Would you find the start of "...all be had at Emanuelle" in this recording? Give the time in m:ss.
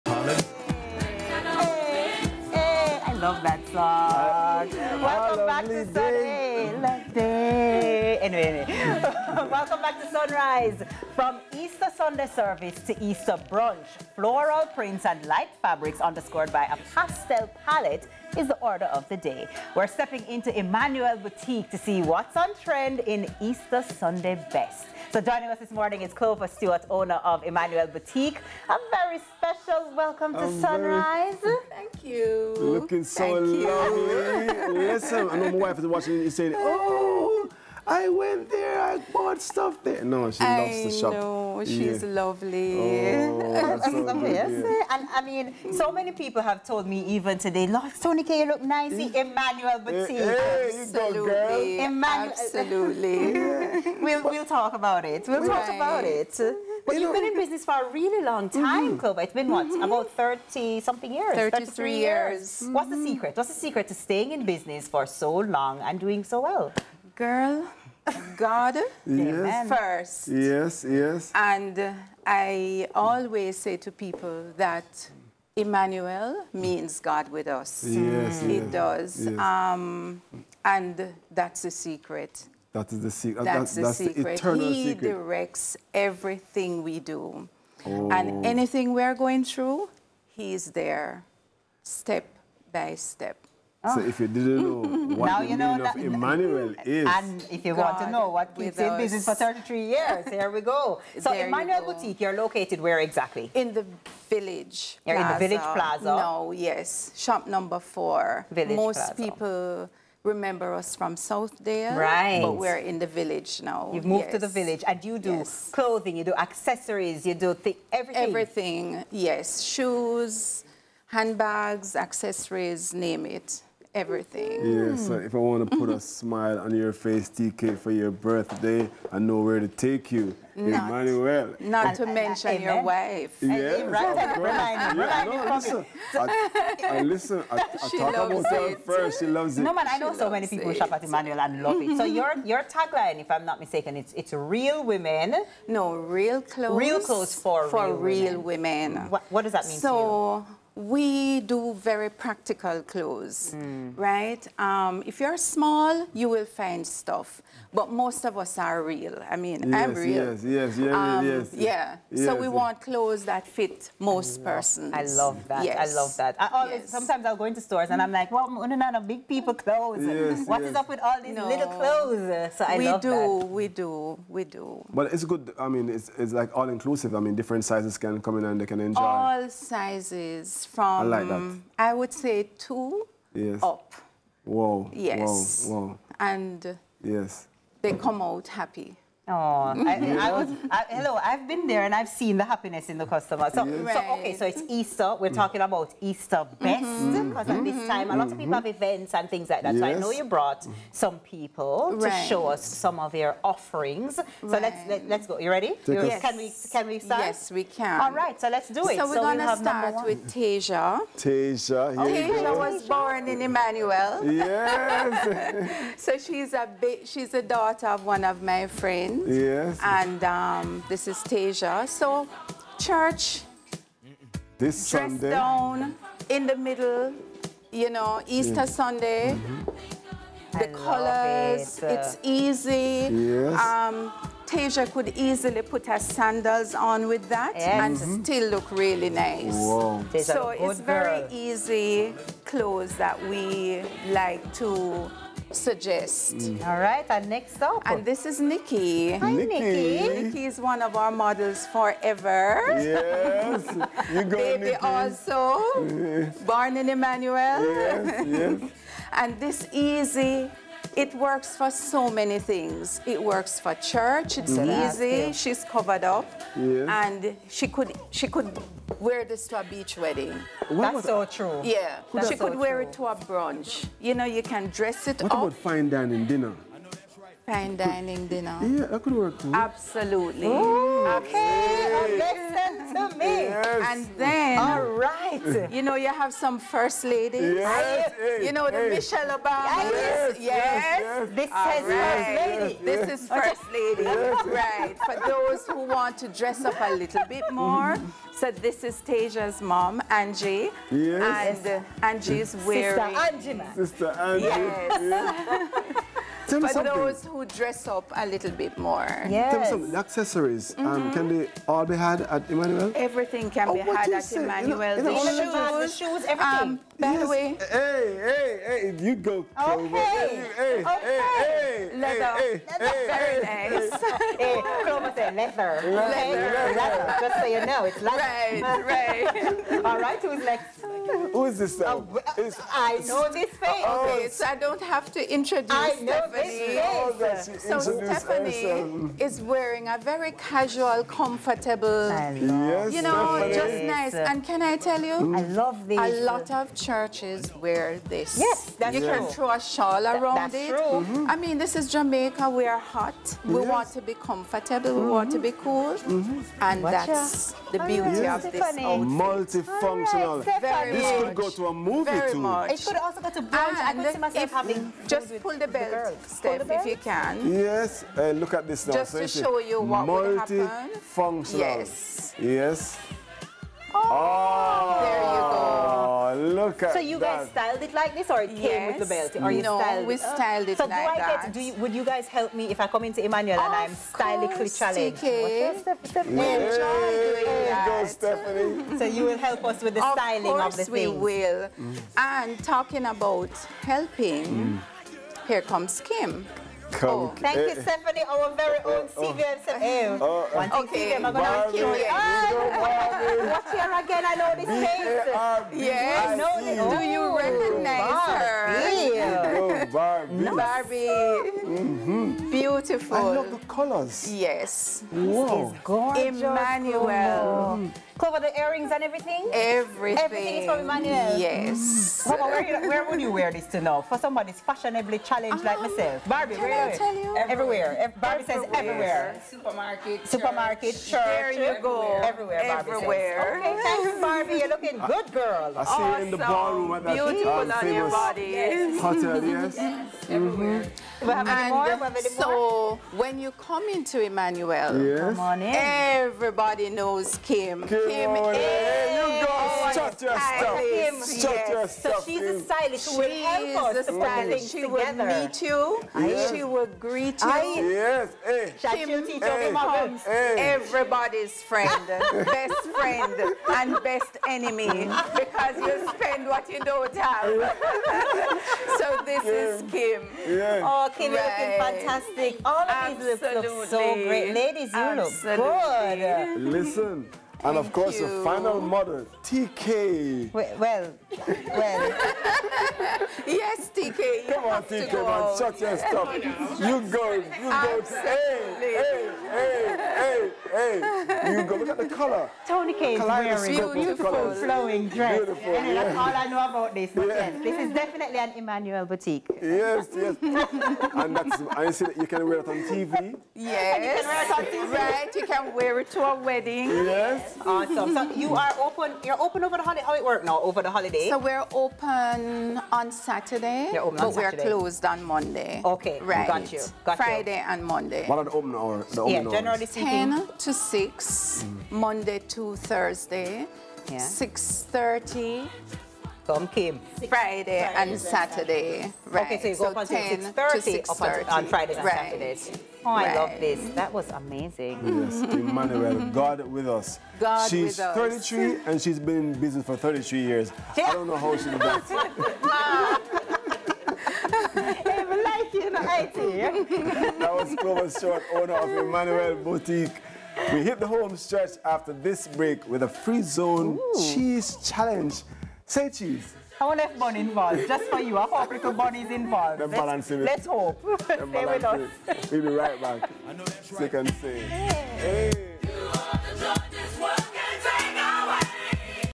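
5:11.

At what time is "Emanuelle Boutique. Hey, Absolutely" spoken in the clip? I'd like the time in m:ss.
0:49.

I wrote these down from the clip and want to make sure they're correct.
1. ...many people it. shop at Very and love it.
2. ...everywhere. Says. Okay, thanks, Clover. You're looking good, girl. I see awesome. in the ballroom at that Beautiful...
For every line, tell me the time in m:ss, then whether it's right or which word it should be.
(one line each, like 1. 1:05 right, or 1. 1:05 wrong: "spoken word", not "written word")
1. 2:20 wrong: "Emanuelle", not "Very"
2. 7:12 wrong: "Barbie", not "Clover".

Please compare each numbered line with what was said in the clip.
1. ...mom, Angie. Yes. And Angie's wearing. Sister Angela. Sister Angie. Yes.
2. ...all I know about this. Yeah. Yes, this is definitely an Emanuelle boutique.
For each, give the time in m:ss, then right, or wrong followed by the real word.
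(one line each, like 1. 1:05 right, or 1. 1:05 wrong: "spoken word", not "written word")
1. 4:59 right
2. 8:16 right.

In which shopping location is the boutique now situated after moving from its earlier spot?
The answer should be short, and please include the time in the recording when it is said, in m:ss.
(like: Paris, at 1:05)
Village Plaza, at 1:45.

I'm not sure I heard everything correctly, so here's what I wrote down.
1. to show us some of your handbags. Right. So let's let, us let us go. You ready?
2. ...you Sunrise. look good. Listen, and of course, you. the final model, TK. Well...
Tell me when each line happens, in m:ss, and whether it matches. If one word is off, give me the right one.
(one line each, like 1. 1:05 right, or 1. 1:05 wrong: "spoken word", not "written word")
1. 3:22 wrong: "offerings", not "handbags"
2. 7:54 wrong: "Absolutely", not "Sunrise".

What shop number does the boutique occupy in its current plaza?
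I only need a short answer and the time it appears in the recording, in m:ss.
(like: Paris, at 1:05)
Number 4, at 1:47.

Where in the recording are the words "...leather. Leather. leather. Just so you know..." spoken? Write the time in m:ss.
5:25.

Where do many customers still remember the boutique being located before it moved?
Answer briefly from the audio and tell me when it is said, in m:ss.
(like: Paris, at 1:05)
Southdale, at 1:51.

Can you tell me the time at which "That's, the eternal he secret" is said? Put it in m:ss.
1:24.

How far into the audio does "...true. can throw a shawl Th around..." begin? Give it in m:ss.
5:49.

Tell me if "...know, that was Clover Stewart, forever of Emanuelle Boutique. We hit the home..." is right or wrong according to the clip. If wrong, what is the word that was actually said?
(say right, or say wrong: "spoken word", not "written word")
wrong: "owner", not "forever".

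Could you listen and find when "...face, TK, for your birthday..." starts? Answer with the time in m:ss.
2:06.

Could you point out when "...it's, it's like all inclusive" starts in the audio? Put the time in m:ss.
2:55.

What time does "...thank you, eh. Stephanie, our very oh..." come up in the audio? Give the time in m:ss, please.
6:37.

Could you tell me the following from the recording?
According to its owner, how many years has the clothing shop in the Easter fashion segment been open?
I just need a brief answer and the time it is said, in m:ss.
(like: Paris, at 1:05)
33, at 1:01.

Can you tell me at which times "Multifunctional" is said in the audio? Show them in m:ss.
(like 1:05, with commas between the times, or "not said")
5:59, 6:10.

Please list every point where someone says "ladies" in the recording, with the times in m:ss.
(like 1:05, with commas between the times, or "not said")
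4:47, 7:54.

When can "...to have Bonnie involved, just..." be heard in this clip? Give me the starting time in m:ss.
9:16.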